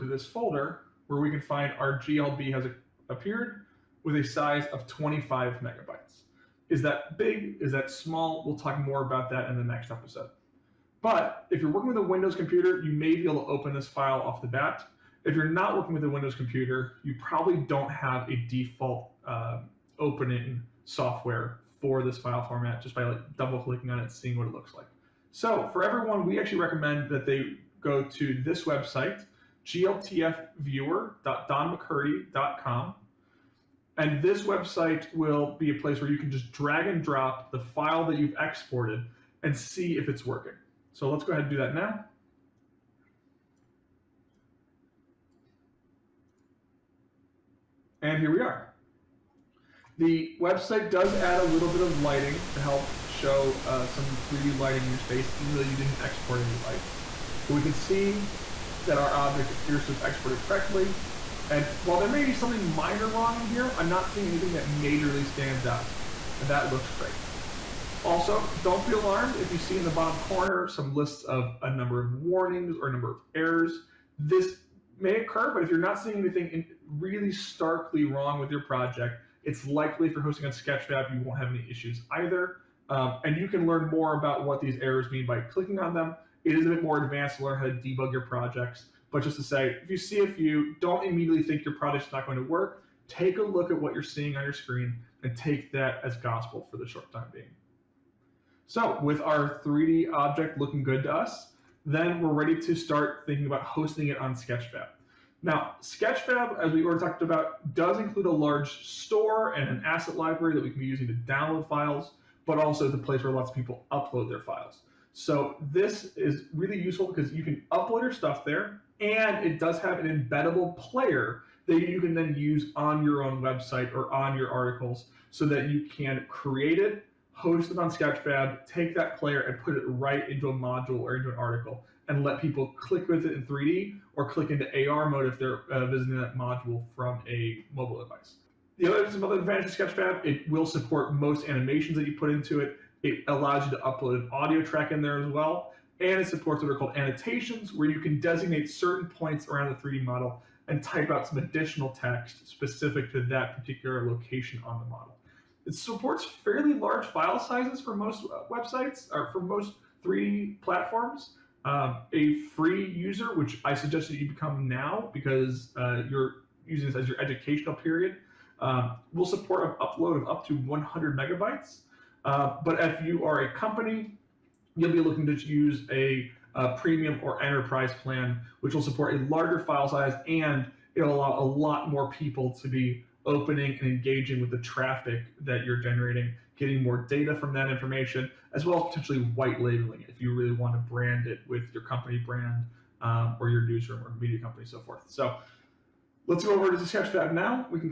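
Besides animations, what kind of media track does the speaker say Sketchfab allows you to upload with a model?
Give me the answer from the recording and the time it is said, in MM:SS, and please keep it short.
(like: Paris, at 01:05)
audio track, at 02:24.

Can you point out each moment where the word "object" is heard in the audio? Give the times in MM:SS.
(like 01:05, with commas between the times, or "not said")
00:59, 01:40.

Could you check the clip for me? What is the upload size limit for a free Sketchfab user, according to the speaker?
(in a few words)
100 megabytes.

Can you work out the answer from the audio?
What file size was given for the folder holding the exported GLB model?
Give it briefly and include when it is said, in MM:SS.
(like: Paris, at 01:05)
25 megabytes, at 00:04.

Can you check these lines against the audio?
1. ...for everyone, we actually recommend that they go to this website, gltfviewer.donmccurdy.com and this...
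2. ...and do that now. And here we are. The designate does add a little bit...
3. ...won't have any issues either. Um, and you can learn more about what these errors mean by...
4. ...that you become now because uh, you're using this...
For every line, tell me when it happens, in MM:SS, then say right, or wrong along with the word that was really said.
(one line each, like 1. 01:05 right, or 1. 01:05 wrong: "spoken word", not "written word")
1. 00:25 right
2. 00:41 wrong: "website", not "designate"
3. 01:21 right
4. 02:44 right.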